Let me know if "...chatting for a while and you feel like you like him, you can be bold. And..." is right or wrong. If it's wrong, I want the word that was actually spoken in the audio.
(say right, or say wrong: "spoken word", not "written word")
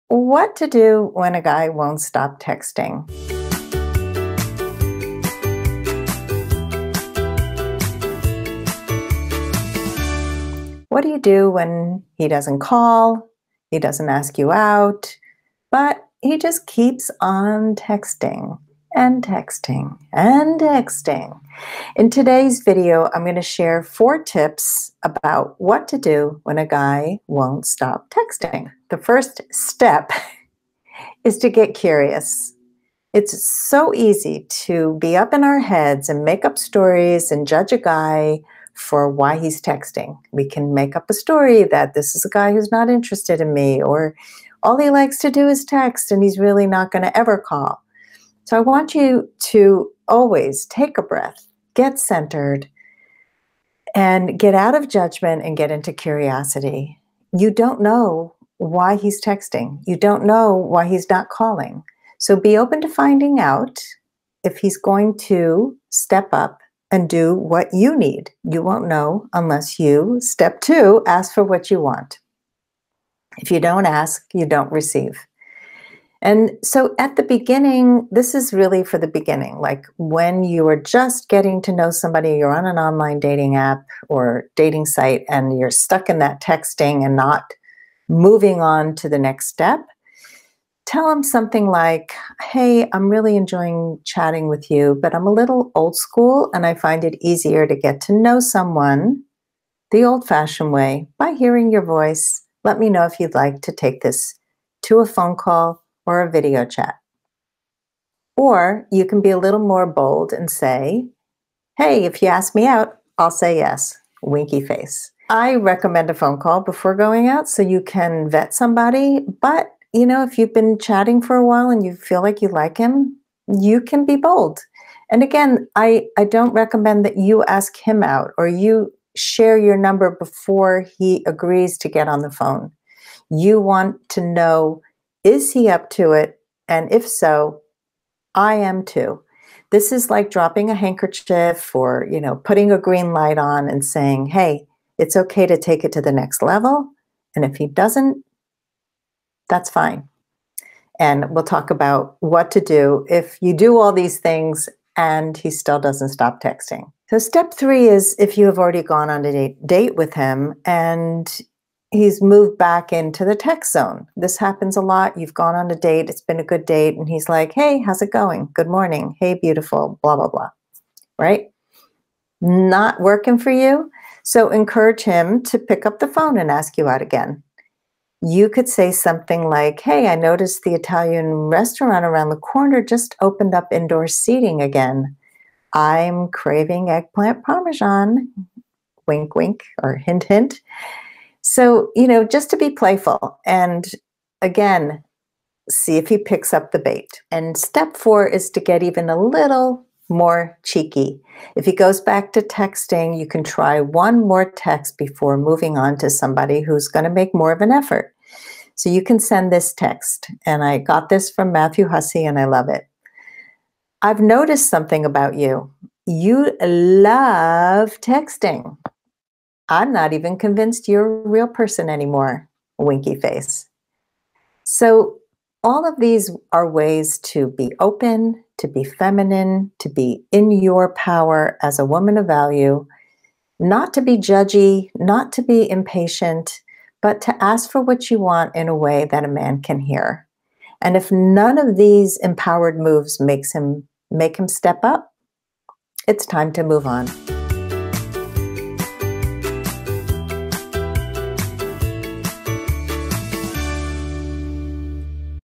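right.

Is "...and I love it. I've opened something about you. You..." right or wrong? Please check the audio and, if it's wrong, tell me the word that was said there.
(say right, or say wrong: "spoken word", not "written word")
wrong: "noticed", not "opened".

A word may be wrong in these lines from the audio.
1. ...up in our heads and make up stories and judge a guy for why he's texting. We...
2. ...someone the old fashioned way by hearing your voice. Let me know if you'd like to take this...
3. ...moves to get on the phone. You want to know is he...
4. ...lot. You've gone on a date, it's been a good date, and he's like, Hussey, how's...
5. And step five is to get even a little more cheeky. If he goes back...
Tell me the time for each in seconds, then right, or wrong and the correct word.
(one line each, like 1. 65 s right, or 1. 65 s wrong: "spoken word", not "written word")
1. 35 s right
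2. 98 s right
3. 131 s wrong: "agrees", not "moves"
4. 164 s wrong: "Hey", not "Hussey"
5. 197 s wrong: "four", not "five".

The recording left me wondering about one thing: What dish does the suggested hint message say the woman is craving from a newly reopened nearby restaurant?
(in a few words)
Eggplant parmesan.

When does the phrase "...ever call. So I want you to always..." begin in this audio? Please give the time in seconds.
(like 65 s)
47 s.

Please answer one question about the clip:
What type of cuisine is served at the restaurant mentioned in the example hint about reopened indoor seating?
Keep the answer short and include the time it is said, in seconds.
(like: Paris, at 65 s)
Italian, at 180 s.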